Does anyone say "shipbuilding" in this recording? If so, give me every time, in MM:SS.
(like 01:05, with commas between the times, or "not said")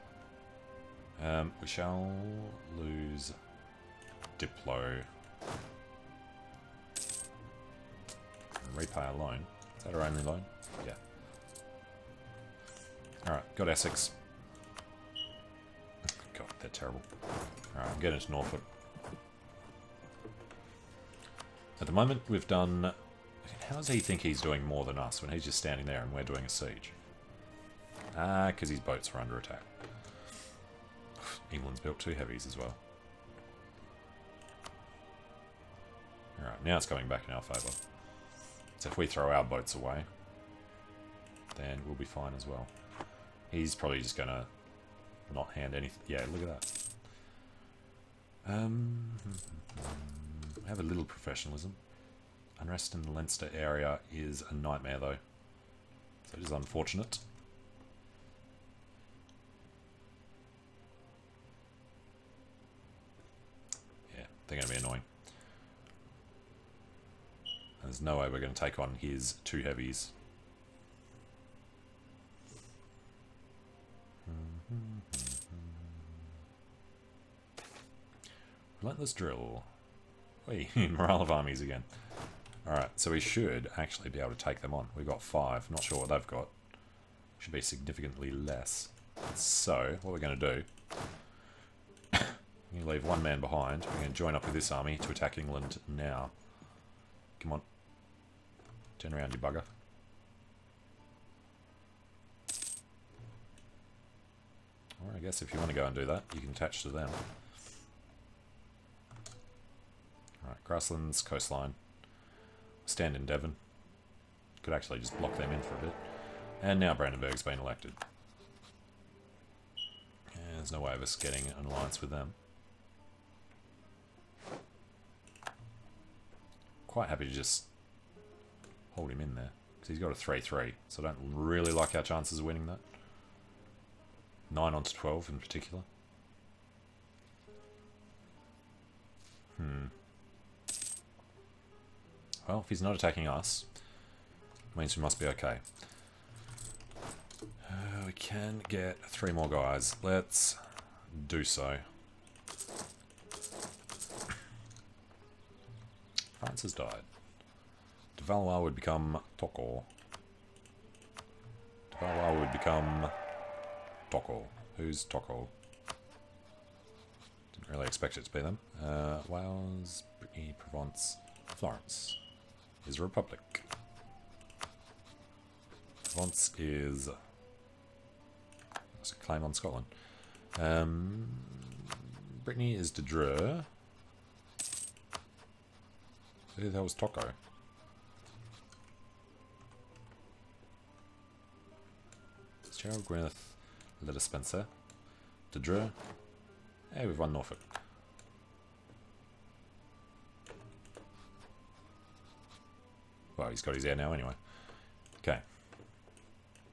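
not said.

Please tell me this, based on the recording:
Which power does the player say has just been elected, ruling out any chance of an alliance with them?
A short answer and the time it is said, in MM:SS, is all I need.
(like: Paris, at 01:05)
Brandenburg, at 01:56.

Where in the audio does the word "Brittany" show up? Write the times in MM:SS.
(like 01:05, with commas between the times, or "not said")
02:50, 03:02.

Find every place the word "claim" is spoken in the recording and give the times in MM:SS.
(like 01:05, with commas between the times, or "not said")
02:59.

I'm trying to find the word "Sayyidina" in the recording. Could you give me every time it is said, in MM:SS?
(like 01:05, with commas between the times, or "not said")
not said.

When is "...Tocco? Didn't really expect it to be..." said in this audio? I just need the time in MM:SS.
02:45.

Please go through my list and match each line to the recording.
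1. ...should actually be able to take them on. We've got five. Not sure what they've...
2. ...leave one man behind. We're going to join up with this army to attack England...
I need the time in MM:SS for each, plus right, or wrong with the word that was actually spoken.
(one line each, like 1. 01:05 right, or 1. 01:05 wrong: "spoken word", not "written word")
1. 01:23 right
2. 01:32 right.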